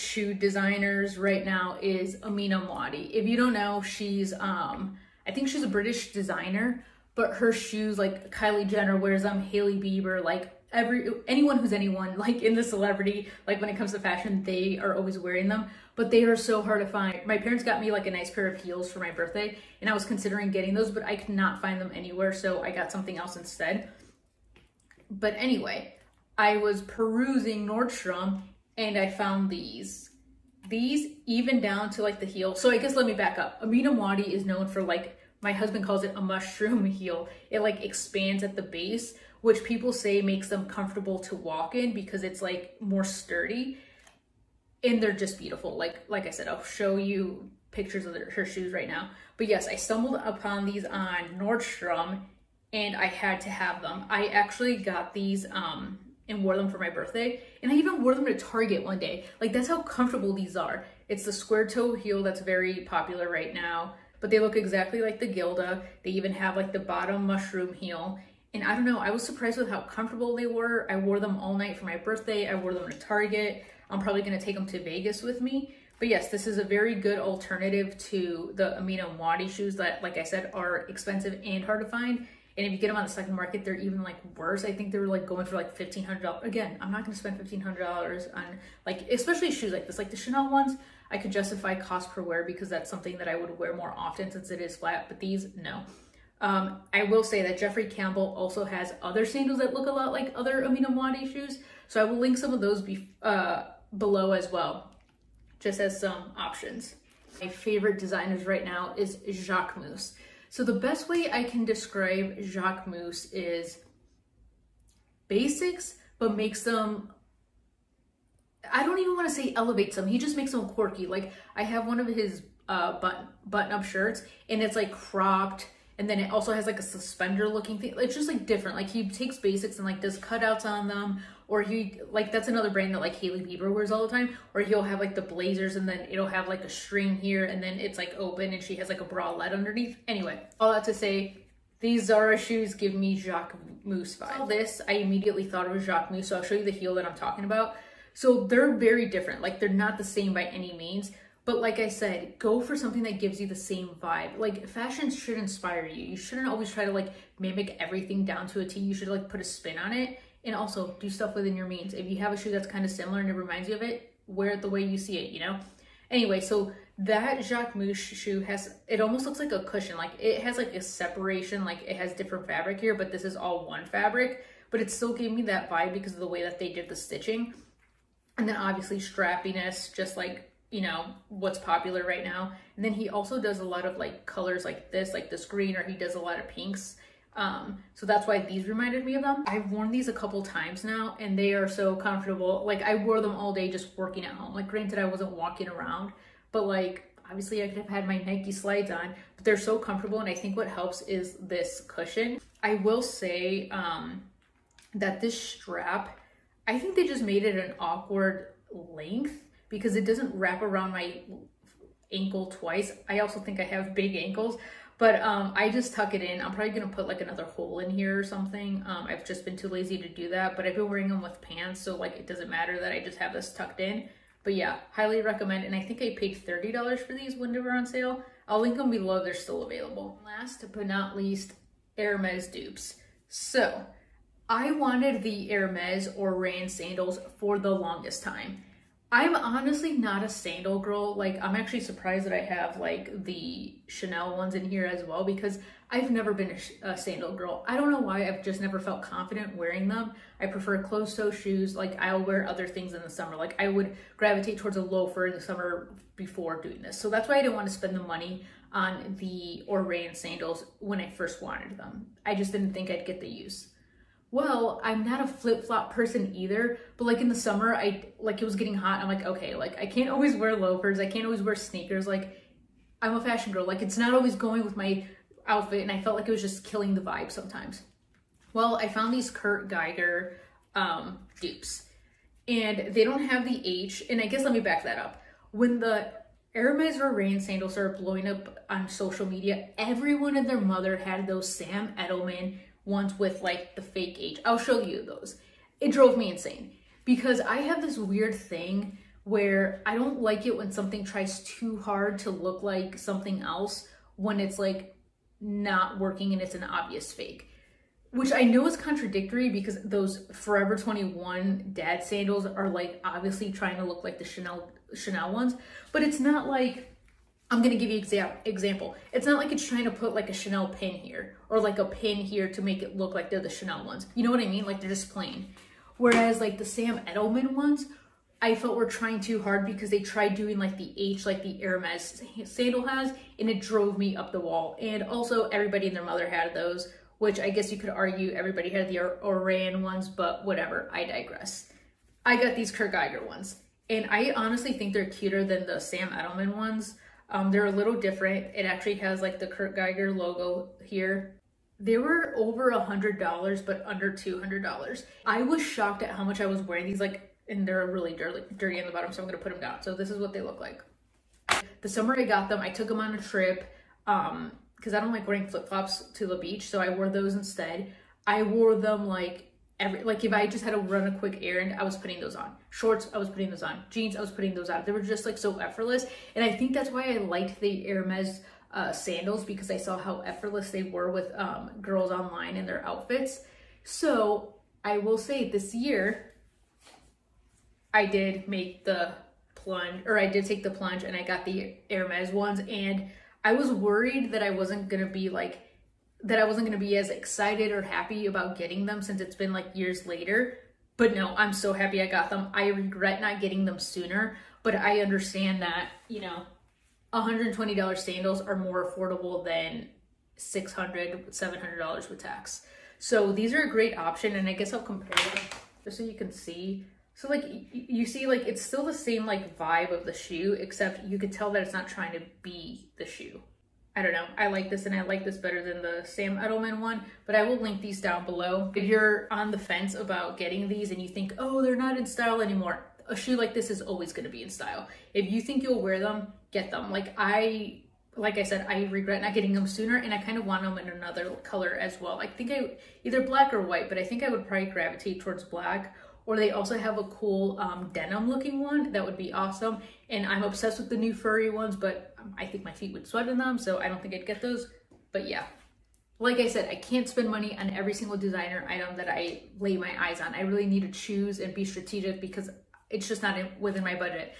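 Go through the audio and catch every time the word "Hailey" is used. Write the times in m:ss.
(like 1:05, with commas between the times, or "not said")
0:09, 2:13.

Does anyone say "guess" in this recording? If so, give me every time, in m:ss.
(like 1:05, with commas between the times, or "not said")
0:32, 4:44, 5:37, 6:54.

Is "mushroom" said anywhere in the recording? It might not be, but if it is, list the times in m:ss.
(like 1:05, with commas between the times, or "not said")
0:36, 1:07.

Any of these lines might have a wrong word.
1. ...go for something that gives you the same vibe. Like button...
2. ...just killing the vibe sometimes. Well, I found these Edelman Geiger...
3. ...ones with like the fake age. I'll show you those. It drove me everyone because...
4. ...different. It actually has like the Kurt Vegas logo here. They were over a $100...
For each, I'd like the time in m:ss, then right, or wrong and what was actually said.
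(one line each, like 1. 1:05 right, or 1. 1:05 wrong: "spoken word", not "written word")
1. 2:32 wrong: "fashion", not "button"
2. 4:36 wrong: "Kurt", not "Edelman"
3. 4:52 wrong: "insane", not "everyone"
4. 5:47 wrong: "Geiger", not "Vegas".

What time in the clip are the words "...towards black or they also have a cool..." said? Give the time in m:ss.
7:25.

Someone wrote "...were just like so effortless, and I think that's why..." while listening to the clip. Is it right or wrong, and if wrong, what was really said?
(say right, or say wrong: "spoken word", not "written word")
right.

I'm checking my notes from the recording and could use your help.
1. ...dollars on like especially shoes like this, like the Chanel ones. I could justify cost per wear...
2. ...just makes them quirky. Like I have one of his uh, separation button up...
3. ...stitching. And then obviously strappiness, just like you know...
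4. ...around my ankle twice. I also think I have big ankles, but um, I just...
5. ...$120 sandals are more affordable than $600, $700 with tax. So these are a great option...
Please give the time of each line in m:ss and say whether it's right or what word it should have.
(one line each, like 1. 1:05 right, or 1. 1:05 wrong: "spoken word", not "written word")
1. 1:27 right
2. 2:00 wrong: "button", not "separation"
3. 2:56 right
4. 3:30 right
5. 6:47 right.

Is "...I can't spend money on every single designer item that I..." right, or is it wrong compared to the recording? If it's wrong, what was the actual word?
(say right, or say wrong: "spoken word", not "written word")
right.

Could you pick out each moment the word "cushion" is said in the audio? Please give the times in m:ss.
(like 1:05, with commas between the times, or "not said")
2:49, 3:21.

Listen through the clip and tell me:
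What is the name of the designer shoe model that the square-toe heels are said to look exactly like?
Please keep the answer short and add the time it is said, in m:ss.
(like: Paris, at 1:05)
Gilda, at 1:05.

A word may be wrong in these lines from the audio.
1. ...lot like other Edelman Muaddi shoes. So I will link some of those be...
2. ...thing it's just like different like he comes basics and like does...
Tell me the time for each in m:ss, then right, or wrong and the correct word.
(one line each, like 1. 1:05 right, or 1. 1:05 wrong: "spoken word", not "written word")
1. 1:39 wrong: "Amina", not "Edelman"
2. 2:07 wrong: "takes", not "comes".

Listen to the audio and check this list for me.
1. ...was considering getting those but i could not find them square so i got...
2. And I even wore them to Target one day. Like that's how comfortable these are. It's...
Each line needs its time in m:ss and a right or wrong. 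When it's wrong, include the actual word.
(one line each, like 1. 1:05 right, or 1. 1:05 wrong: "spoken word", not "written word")
1. 0:19 wrong: "anywhere", not "square"
2. 0:57 right.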